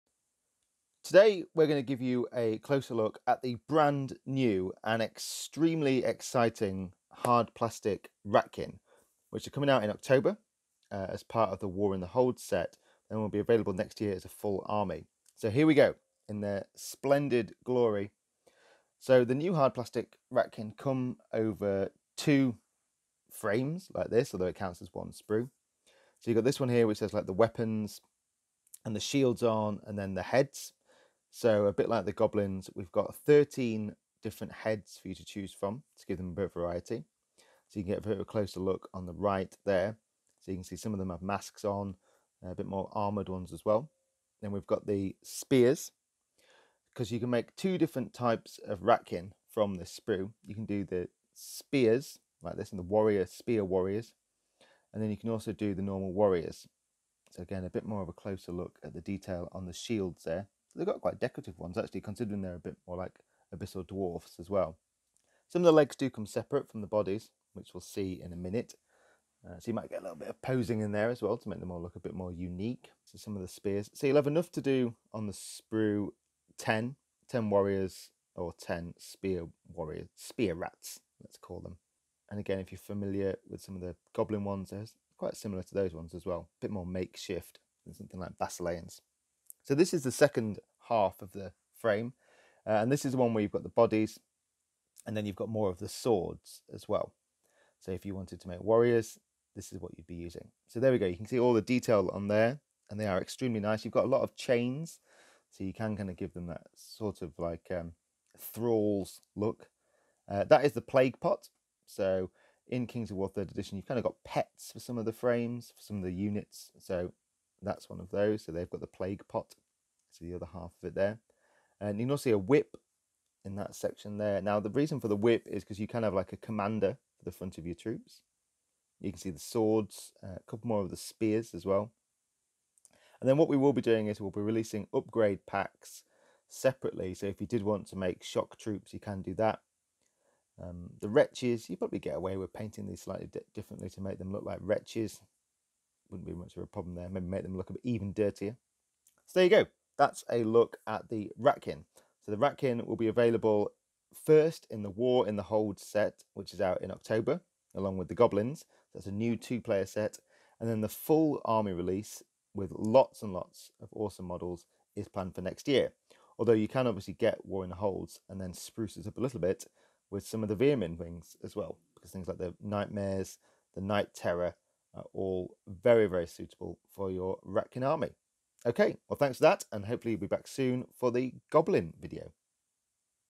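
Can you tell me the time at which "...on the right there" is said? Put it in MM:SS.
00:38.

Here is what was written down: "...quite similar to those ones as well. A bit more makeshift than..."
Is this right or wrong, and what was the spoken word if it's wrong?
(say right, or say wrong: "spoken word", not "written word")
right.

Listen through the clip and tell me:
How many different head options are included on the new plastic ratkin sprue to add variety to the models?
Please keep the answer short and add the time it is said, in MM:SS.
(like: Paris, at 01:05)
13, at 00:33.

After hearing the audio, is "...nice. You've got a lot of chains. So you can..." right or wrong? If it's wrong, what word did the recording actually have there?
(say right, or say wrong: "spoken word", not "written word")
right.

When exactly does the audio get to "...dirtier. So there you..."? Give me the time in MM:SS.
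02:28.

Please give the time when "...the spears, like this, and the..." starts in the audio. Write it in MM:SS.
00:50.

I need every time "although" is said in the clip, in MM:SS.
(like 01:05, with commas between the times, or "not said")
00:24, 02:46.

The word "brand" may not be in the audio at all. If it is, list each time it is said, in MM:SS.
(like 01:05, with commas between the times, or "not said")
00:03.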